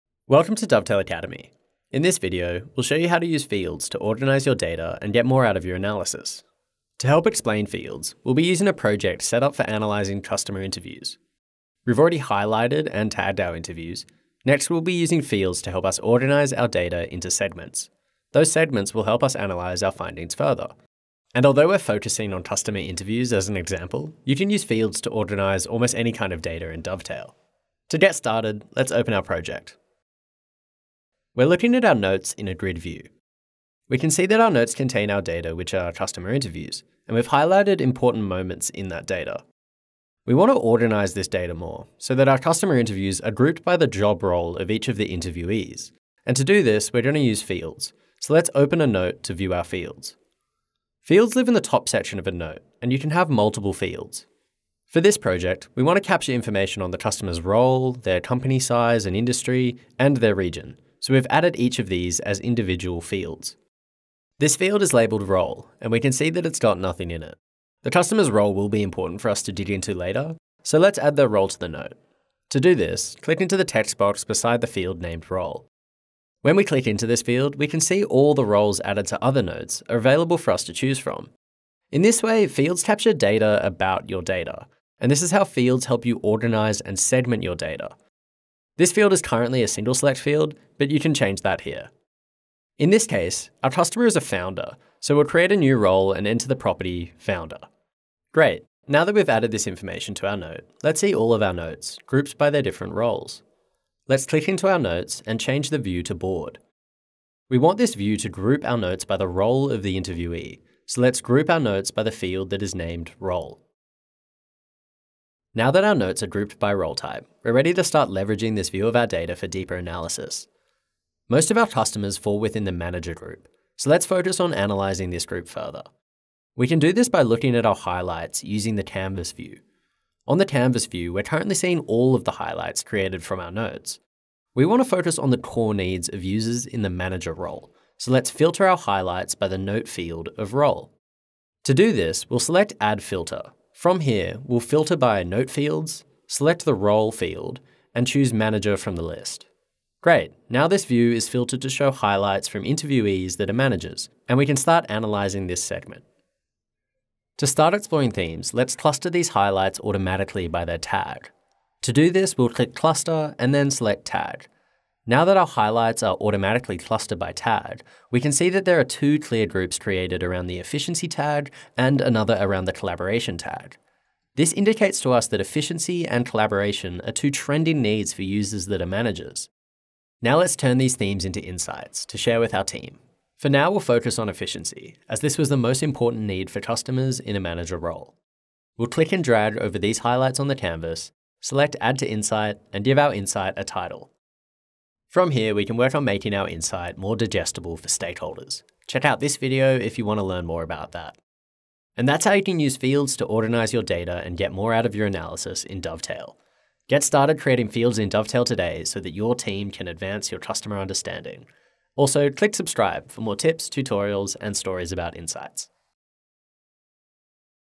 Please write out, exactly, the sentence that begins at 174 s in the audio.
This indicates to us that efficiency and collaboration are two trending needs for users that are managers.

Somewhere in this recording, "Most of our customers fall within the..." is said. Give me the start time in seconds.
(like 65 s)
121 s.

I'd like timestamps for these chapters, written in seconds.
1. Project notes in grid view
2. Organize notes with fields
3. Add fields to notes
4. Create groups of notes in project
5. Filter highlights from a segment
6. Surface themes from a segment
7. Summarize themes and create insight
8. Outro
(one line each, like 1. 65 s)
1. 28 s
2. 40 s
3. 64 s
4. 98 s
5. 116 s
6. 150 s
7. 180 s
8. 202 s.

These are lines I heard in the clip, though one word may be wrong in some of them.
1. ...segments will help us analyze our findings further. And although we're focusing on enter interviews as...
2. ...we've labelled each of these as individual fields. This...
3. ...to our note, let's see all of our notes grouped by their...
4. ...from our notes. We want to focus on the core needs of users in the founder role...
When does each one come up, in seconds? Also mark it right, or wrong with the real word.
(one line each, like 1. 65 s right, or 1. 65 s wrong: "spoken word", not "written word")
1. 18 s wrong: "customer", not "enter"
2. 61 s wrong: "added", not "labelled"
3. 100 s right
4. 133 s wrong: "manager", not "founder".